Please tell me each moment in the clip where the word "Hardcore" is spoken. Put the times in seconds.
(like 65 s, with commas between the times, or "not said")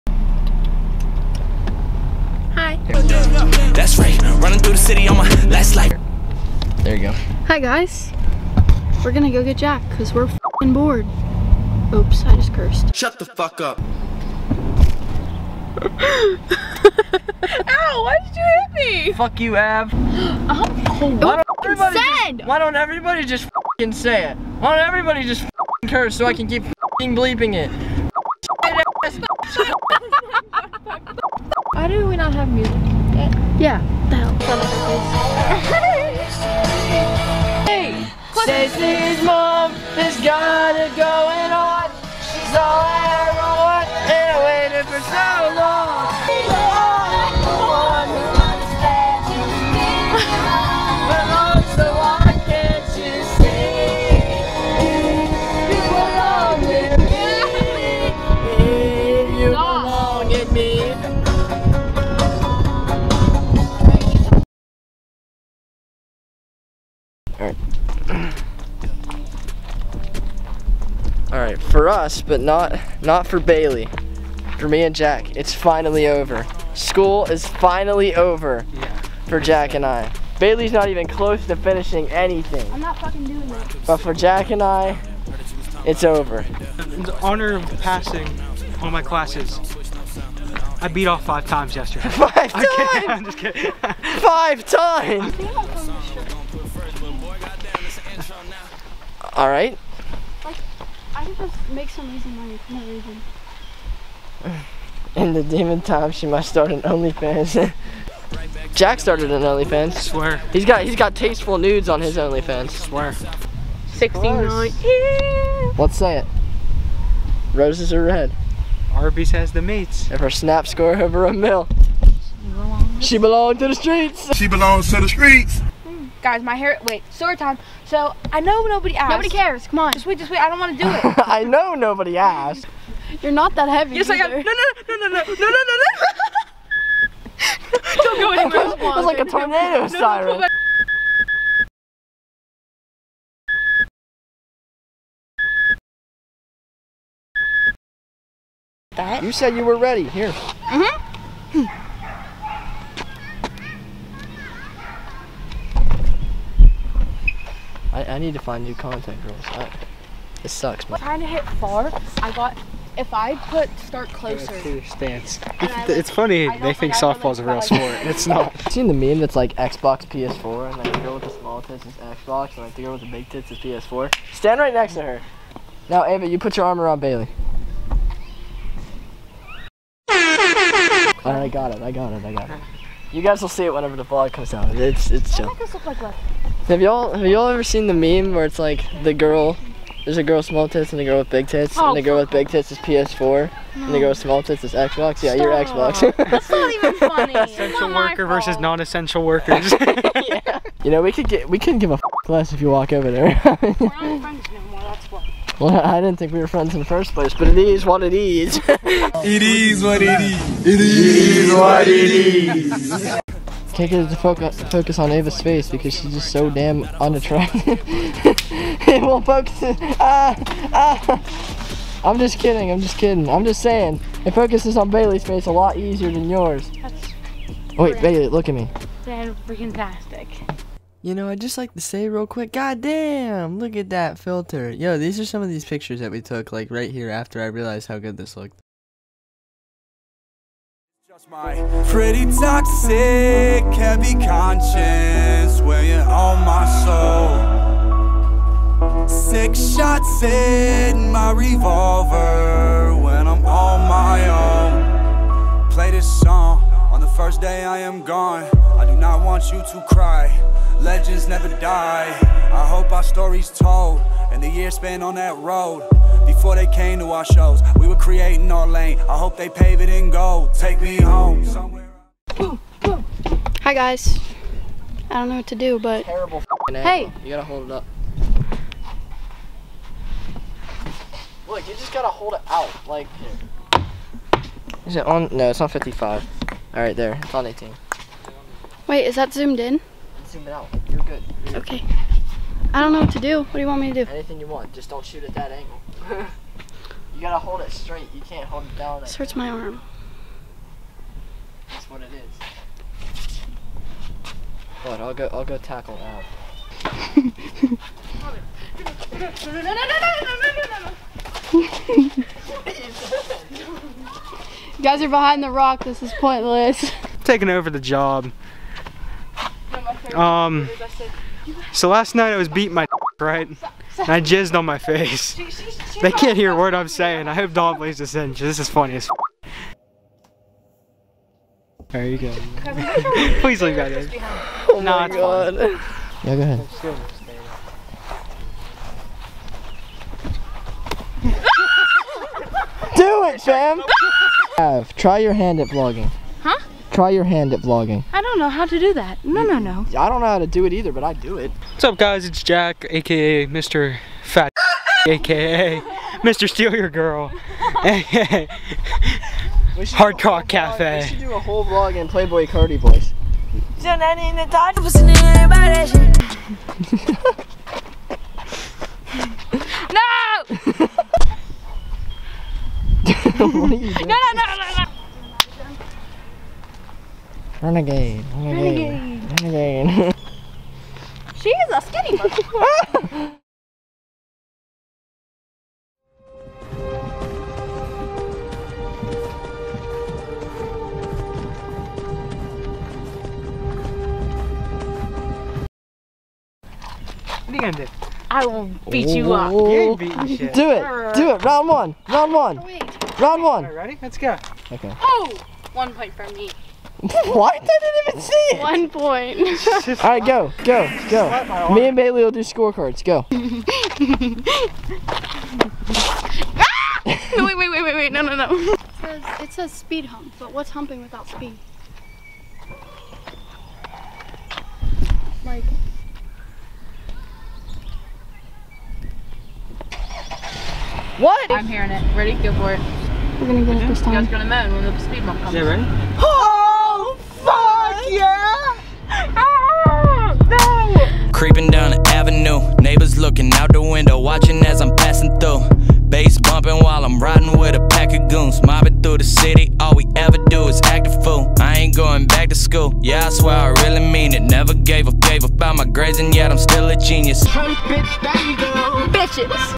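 359 s.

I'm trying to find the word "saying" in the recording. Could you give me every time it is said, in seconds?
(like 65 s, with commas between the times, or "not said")
223 s, 326 s.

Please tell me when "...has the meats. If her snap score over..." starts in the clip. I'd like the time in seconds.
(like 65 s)
119 s.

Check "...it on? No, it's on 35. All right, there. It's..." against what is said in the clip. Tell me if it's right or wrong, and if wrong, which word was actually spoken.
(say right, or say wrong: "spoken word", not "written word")
wrong: "55", not "35".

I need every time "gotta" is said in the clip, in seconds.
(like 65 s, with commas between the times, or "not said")
277 s, 281 s, 297 s.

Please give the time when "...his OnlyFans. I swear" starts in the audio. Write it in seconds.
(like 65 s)
112 s.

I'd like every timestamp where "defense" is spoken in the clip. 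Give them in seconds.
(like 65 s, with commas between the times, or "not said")
not said.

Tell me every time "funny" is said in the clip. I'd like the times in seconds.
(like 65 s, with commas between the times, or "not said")
166 s, 196 s, 328 s.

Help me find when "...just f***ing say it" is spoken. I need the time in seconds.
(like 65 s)
23 s.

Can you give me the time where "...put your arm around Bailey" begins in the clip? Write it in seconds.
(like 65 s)
176 s.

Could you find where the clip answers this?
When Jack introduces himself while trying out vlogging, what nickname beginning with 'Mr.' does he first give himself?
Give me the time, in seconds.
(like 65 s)
353 s.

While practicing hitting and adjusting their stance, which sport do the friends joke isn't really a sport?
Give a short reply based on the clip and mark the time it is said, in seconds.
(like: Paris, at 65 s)
Softball, at 166 s.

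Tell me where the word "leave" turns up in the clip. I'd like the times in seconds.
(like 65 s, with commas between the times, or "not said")
333 s.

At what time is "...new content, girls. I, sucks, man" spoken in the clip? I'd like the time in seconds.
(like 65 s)
158 s.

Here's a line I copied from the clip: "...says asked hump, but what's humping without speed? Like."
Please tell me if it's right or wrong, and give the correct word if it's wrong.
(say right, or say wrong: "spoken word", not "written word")
wrong: "speed", not "asked".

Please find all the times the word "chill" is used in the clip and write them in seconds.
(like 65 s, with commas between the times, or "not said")
185 s.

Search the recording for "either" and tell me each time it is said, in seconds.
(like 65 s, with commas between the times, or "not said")
134 s, 350 s.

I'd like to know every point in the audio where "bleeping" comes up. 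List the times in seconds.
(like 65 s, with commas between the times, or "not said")
27 s.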